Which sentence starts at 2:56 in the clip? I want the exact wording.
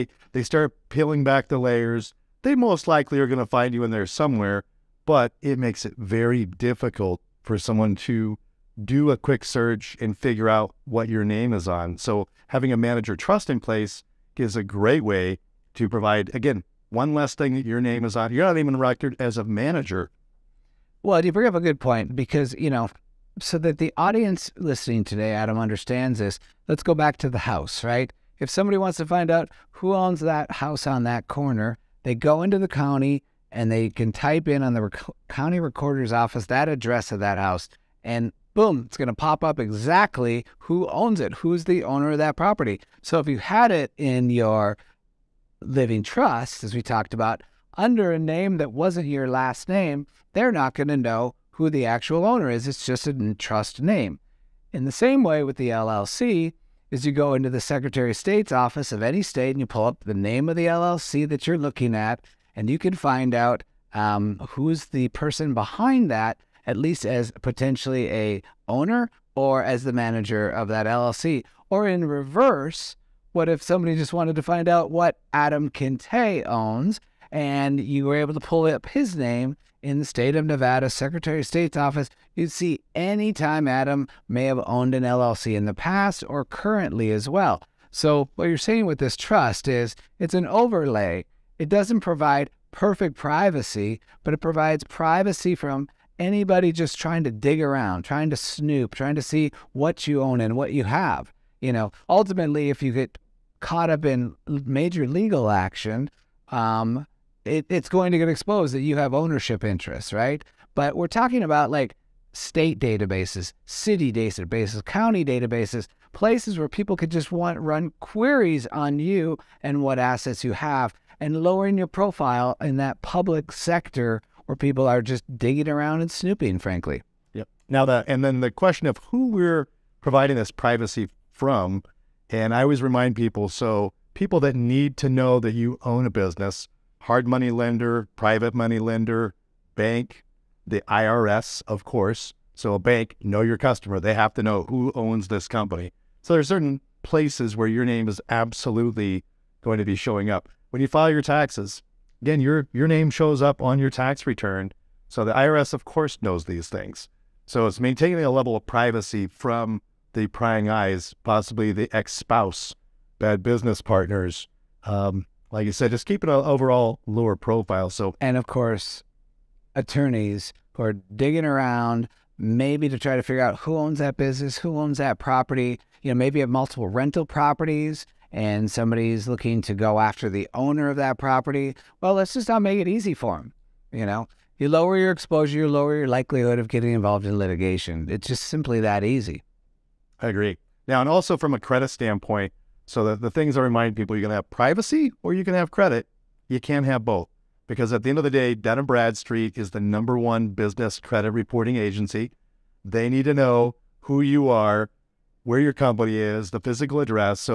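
You know, maybe you have multiple rental properties and somebody's looking to go after the owner of that property.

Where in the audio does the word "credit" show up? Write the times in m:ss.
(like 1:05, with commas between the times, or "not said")
3:11, 3:15, 3:20.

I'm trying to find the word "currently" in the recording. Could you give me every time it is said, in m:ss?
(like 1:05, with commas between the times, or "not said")
1:26.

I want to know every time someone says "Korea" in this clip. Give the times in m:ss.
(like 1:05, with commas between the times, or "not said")
not said.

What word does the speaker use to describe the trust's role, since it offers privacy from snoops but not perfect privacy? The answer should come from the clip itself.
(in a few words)
Overlay.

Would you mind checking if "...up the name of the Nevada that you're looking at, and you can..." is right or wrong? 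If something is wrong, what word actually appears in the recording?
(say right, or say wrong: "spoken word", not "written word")
wrong: "LLC", not "Nevada".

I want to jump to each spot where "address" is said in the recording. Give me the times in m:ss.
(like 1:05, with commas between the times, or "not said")
0:36, 3:26.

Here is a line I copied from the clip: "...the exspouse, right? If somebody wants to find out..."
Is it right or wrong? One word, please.
wrong.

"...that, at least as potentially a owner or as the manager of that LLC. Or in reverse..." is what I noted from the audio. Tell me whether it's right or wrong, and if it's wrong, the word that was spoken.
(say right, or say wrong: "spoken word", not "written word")
right.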